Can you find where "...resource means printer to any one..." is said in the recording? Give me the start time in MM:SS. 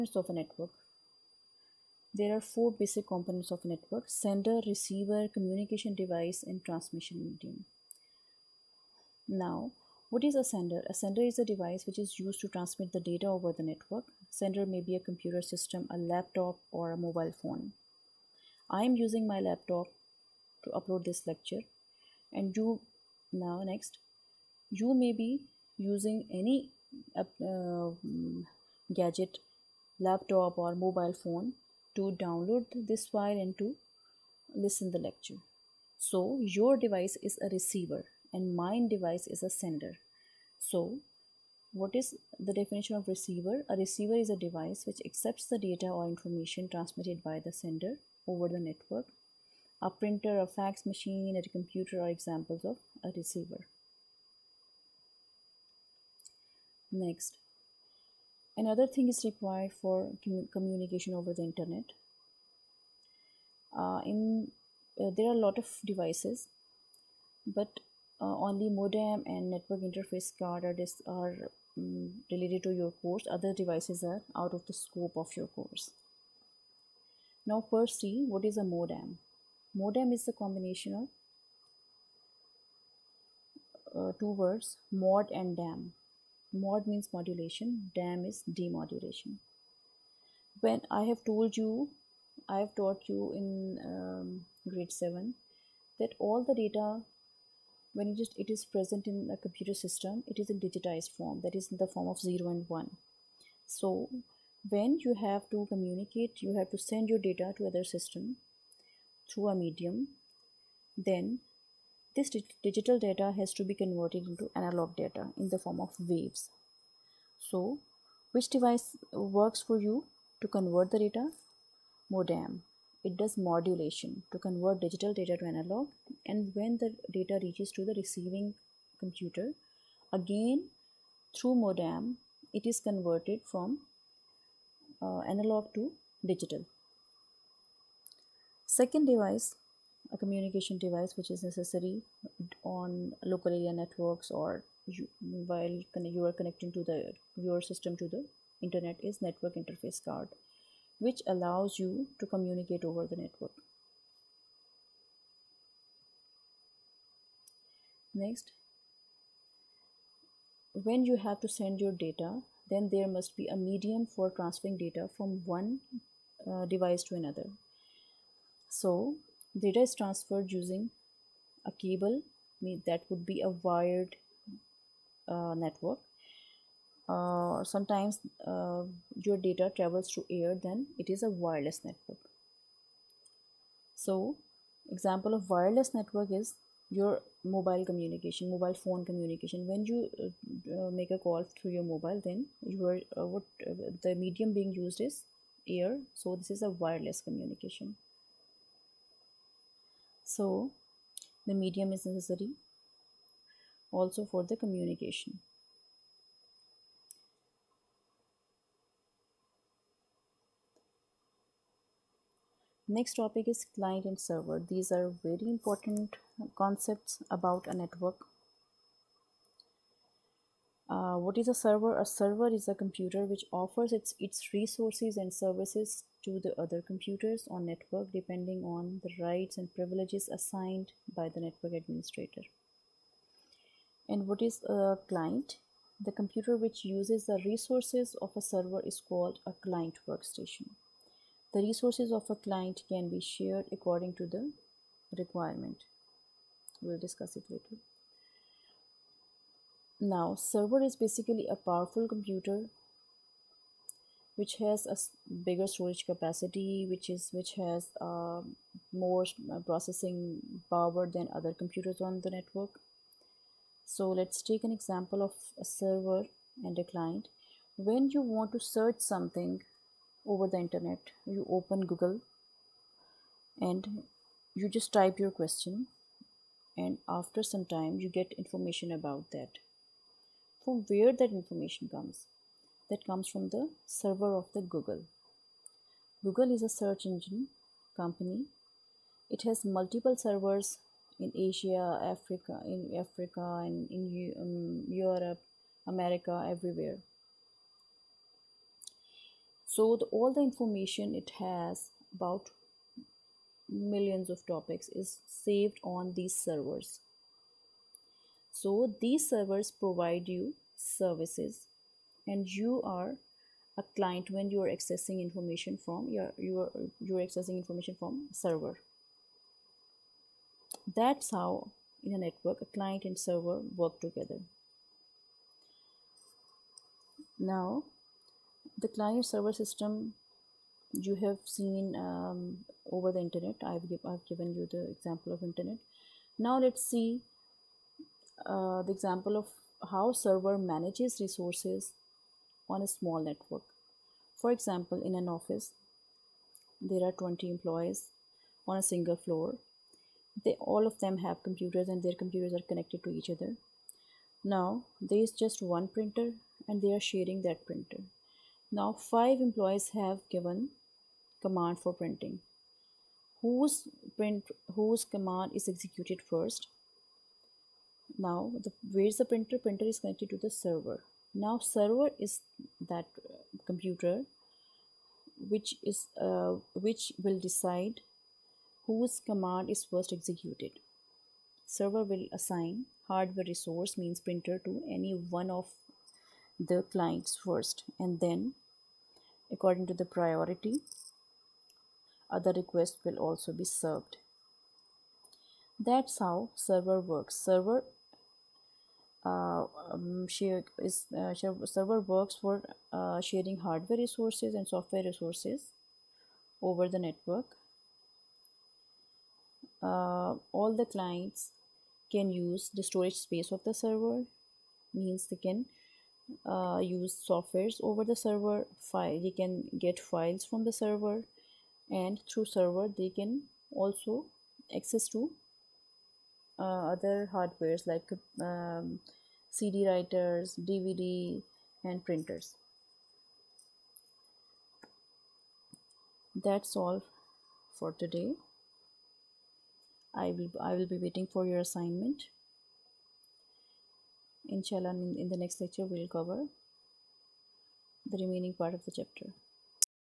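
06:23.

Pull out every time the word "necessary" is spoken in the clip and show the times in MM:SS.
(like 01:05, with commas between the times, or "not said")
02:21, 03:22.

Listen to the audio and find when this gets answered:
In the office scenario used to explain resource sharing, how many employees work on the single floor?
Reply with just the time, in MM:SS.
05:47.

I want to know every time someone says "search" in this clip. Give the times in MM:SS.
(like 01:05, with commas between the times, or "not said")
04:28, 04:46.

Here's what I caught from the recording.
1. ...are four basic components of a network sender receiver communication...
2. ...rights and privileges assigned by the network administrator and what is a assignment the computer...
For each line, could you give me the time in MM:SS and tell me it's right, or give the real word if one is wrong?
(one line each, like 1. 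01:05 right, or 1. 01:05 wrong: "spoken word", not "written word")
1. 00:02 right
2. 03:49 wrong: "client", not "assignment".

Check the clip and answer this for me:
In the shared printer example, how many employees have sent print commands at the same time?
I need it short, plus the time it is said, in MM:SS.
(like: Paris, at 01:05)
5, at 05:58.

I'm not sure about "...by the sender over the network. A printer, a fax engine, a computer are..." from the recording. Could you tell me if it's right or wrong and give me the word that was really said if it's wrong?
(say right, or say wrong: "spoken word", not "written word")
wrong: "machine", not "engine".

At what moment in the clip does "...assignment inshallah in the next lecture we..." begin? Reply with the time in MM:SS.
07:21.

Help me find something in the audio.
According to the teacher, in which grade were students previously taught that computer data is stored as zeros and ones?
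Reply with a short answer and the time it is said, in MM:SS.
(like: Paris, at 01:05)
7, at 01:34.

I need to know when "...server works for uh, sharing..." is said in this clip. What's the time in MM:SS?
06:41.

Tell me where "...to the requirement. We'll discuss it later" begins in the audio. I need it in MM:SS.
04:04.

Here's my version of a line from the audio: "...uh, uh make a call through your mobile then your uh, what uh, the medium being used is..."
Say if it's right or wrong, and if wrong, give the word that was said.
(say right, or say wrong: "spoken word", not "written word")
right.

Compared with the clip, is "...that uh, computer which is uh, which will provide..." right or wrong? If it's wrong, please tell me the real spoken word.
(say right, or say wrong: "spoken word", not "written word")
wrong: "decide", not "provide".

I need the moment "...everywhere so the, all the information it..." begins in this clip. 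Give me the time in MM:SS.
04:56.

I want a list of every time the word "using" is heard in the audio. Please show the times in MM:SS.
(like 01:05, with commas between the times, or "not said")
00:18, 00:25, 02:50.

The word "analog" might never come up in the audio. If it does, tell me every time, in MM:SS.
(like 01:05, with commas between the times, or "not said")
01:54, 02:05, 02:15.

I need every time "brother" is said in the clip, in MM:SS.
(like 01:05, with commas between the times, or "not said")
not said.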